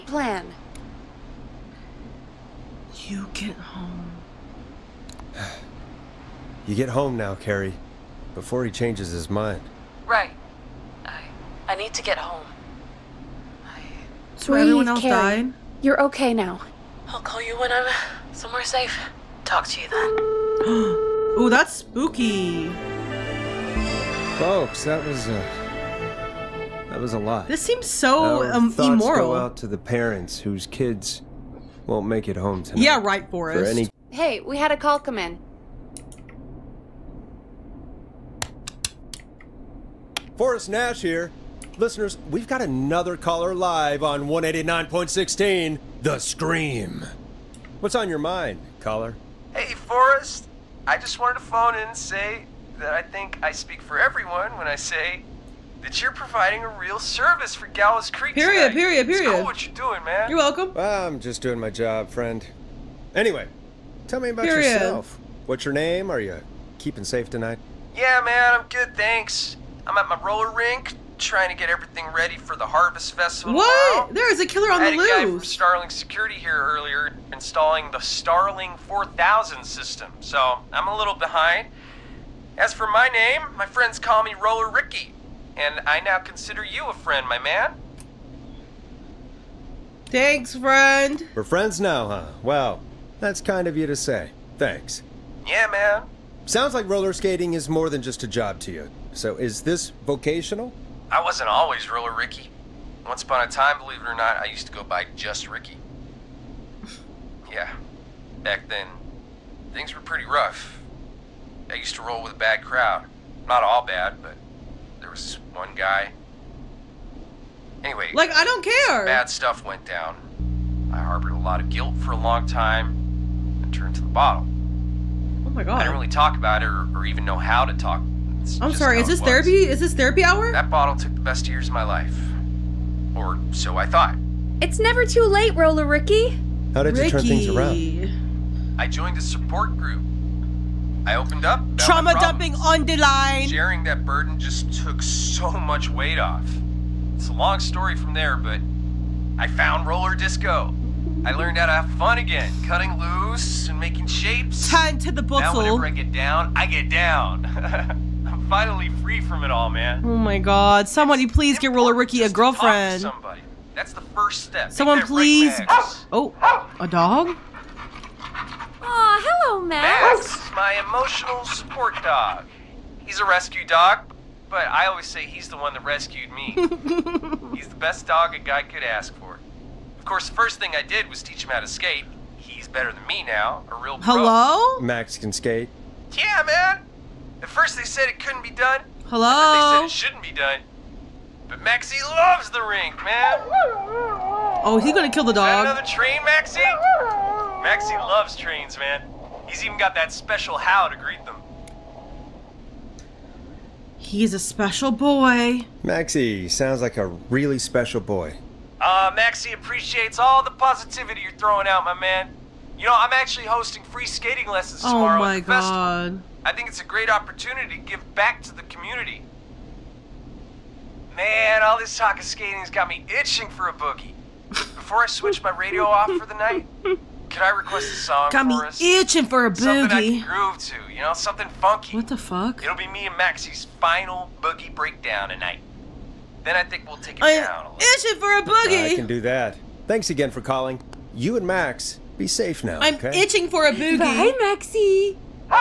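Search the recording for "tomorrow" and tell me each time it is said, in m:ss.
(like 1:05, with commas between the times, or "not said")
1:13, 3:34.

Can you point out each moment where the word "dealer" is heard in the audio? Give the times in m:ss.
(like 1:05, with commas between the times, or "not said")
not said.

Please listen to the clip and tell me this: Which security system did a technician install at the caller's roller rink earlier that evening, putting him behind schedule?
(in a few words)
Starling 4000.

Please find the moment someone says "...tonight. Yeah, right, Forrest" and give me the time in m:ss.
0:32.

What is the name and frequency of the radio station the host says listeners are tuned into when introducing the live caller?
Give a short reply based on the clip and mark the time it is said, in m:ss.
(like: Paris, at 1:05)
189.16, The Scream, at 0:44.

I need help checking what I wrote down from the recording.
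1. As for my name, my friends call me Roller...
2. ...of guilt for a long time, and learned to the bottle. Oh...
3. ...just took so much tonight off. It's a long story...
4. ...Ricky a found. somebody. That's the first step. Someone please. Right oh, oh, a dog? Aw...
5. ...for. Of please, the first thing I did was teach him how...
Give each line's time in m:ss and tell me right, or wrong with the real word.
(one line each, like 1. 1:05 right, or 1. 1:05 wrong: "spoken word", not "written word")
1. 1:22 right
2. 2:01 wrong: "turned", not "learned"
3. 2:24 wrong: "weight", not "tonight"
4. 2:41 wrong: "girlfriend", not "found"
5. 2:59 wrong: "course", not "please".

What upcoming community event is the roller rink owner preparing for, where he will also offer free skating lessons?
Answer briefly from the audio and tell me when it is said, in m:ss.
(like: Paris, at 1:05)
Harvest Festival, at 1:12.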